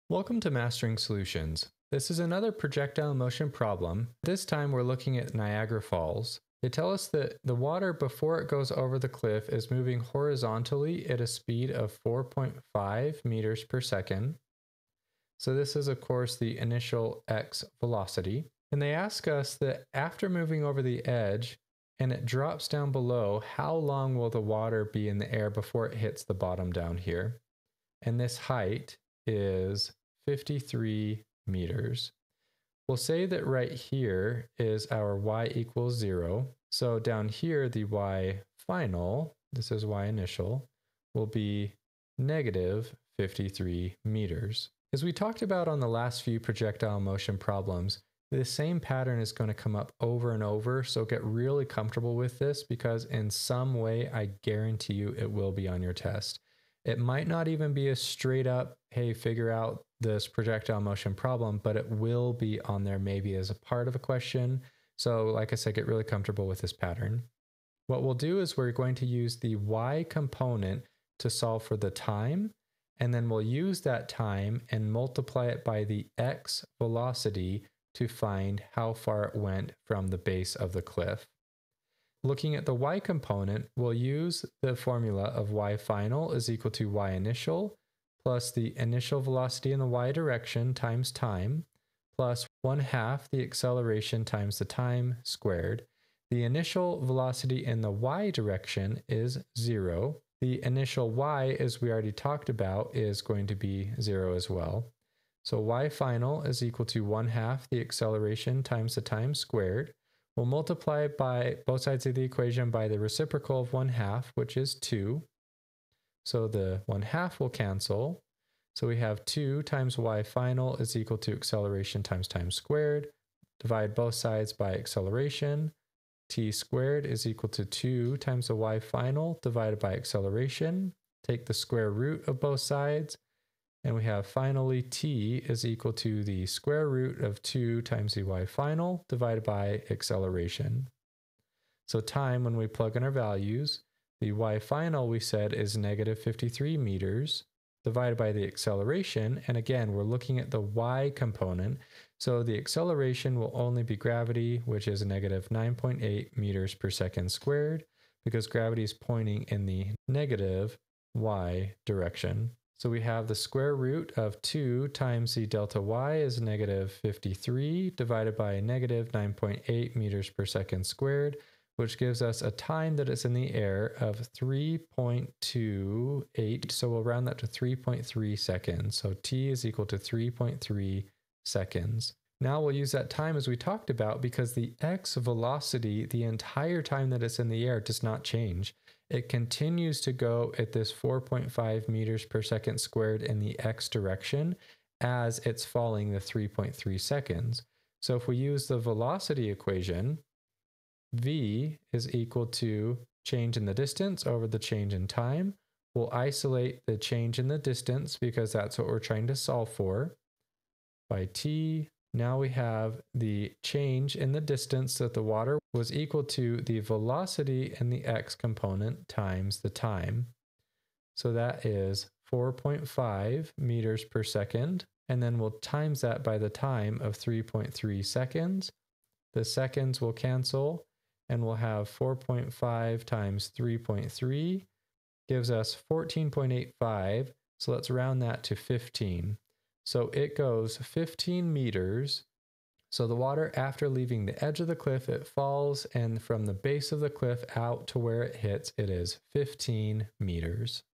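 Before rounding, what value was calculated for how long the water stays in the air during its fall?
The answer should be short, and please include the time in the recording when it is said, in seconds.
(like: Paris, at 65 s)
3.28, at 174 s.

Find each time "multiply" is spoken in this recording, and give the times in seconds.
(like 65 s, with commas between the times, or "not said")
74 s, 110 s.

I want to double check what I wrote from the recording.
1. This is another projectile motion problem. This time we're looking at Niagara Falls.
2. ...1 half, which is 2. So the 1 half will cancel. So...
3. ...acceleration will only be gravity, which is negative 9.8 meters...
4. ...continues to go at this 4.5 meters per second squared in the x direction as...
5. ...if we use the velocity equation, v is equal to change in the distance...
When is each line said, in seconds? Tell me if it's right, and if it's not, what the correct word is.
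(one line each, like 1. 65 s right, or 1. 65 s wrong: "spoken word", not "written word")
1. 1 s right
2. 113 s right
3. 152 s right
4. 189 s right
5. 198 s right.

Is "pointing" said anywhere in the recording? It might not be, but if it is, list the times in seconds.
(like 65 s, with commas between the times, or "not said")
158 s.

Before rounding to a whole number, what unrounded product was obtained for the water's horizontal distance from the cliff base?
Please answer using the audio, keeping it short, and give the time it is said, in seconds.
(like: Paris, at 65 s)
14.85, at 235 s.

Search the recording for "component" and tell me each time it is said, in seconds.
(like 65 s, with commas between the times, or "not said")
70 s, 82 s, 151 s, 218 s.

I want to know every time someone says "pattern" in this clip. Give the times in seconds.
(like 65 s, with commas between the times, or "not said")
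48 s, 66 s.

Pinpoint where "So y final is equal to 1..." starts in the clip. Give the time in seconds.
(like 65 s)
105 s.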